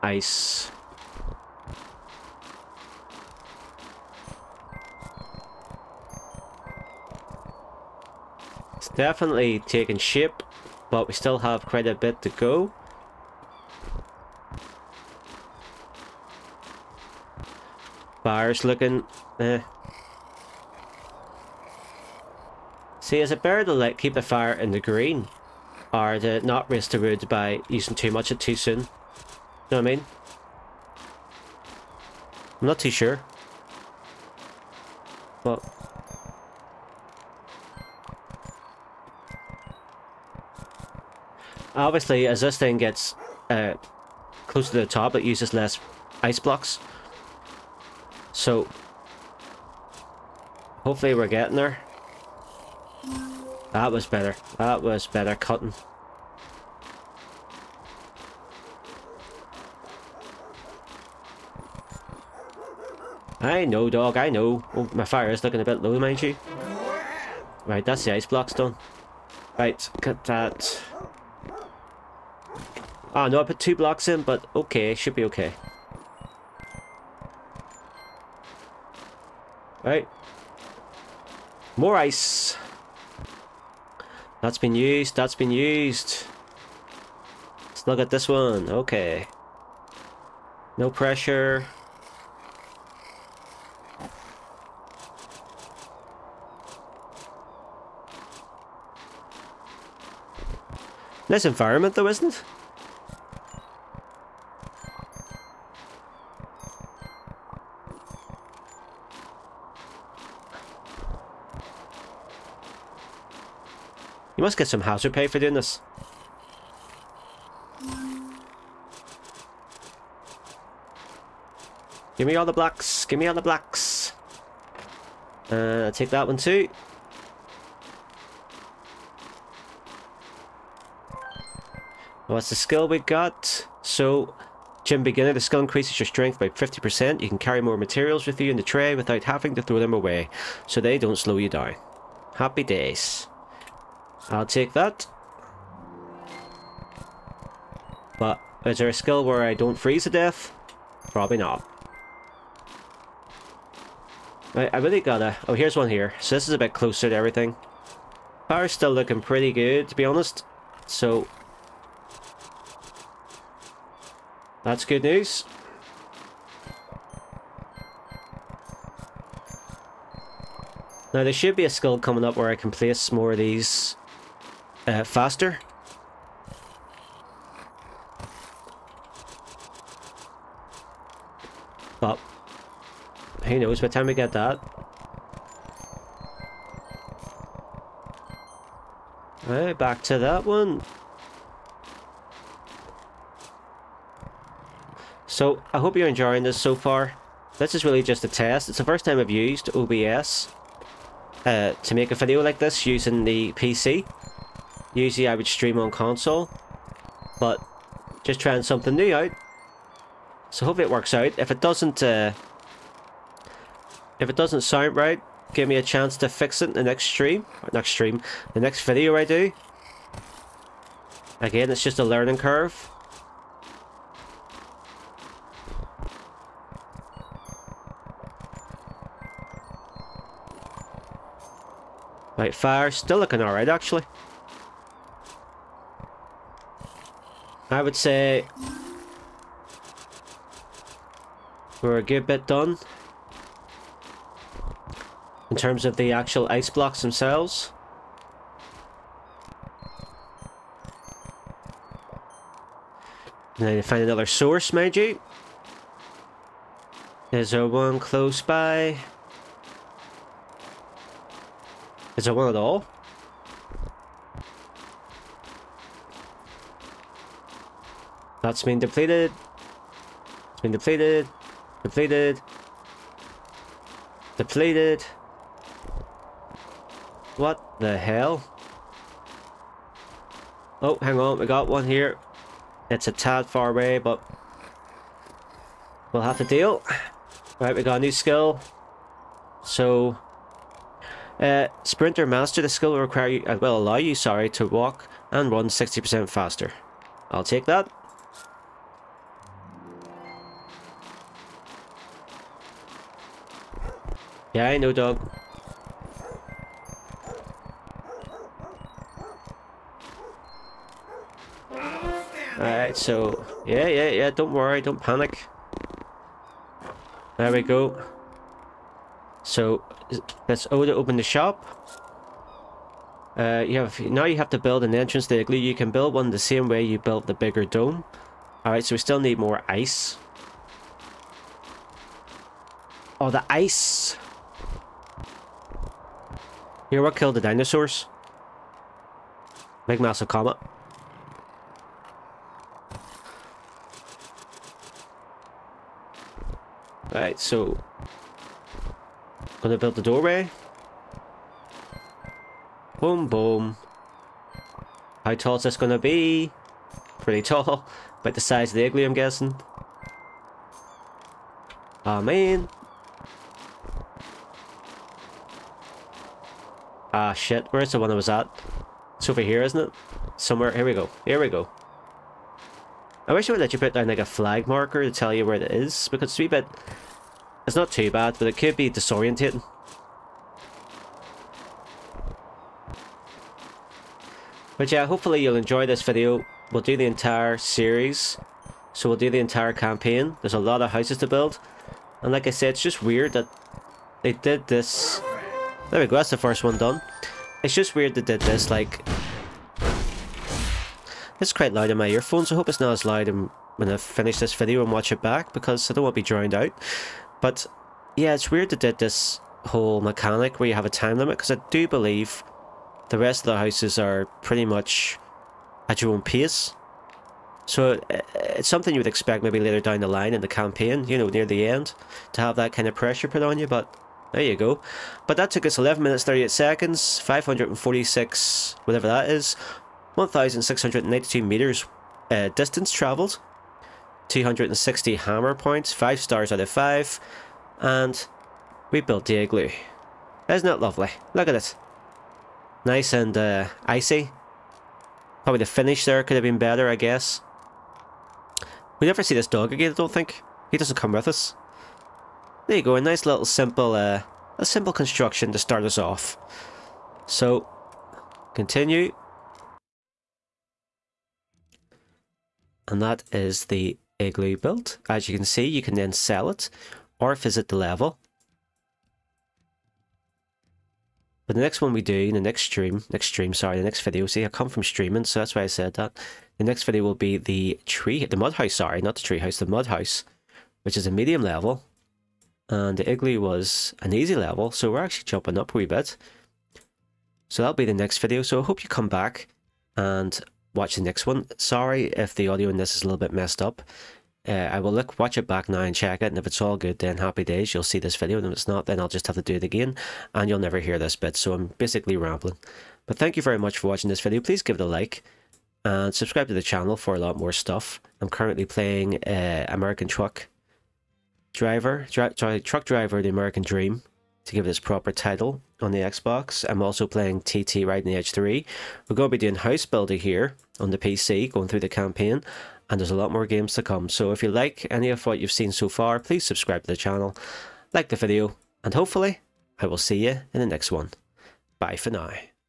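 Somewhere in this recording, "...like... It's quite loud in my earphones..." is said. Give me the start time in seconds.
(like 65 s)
398 s.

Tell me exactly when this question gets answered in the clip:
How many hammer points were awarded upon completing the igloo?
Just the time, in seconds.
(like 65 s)
434 s.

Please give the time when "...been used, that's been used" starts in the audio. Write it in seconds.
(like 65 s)
84 s.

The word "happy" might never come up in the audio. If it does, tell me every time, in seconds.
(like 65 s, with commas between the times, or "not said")
142 s, 497 s.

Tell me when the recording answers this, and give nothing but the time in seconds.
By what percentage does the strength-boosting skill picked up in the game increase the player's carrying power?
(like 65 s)
136 s.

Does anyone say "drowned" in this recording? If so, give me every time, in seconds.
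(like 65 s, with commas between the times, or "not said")
406 s.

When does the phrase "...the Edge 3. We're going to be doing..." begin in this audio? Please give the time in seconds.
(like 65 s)
518 s.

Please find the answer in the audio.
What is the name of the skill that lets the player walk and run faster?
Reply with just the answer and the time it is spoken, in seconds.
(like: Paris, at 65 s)
Sprinter Master, at 291 s.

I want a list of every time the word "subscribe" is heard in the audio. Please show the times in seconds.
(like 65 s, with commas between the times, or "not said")
506 s, 526 s.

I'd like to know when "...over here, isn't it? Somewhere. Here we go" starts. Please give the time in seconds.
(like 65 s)
369 s.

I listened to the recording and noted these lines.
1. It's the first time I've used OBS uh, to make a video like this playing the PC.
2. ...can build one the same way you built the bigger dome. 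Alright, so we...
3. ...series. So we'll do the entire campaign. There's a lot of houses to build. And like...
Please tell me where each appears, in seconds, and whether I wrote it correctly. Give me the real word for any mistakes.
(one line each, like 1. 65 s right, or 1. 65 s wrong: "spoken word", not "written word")
1. 198 s wrong: "using", not "playing"
2. 325 s right
3. 387 s right.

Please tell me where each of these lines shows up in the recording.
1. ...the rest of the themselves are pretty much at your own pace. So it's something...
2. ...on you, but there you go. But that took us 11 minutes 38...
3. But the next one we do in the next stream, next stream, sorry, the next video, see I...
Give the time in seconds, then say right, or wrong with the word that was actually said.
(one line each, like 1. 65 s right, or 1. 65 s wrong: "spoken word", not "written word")
1. 413 s wrong: "houses", not "themselves"
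2. 423 s right
3. 471 s right.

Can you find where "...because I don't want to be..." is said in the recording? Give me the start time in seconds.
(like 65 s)
405 s.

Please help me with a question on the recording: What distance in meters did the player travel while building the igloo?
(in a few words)
1,692 meters.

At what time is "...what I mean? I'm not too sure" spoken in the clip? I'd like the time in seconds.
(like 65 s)
29 s.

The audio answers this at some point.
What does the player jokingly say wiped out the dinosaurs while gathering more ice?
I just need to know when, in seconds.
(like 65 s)
339 s.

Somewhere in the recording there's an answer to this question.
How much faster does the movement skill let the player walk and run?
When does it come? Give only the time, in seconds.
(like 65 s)
295 s.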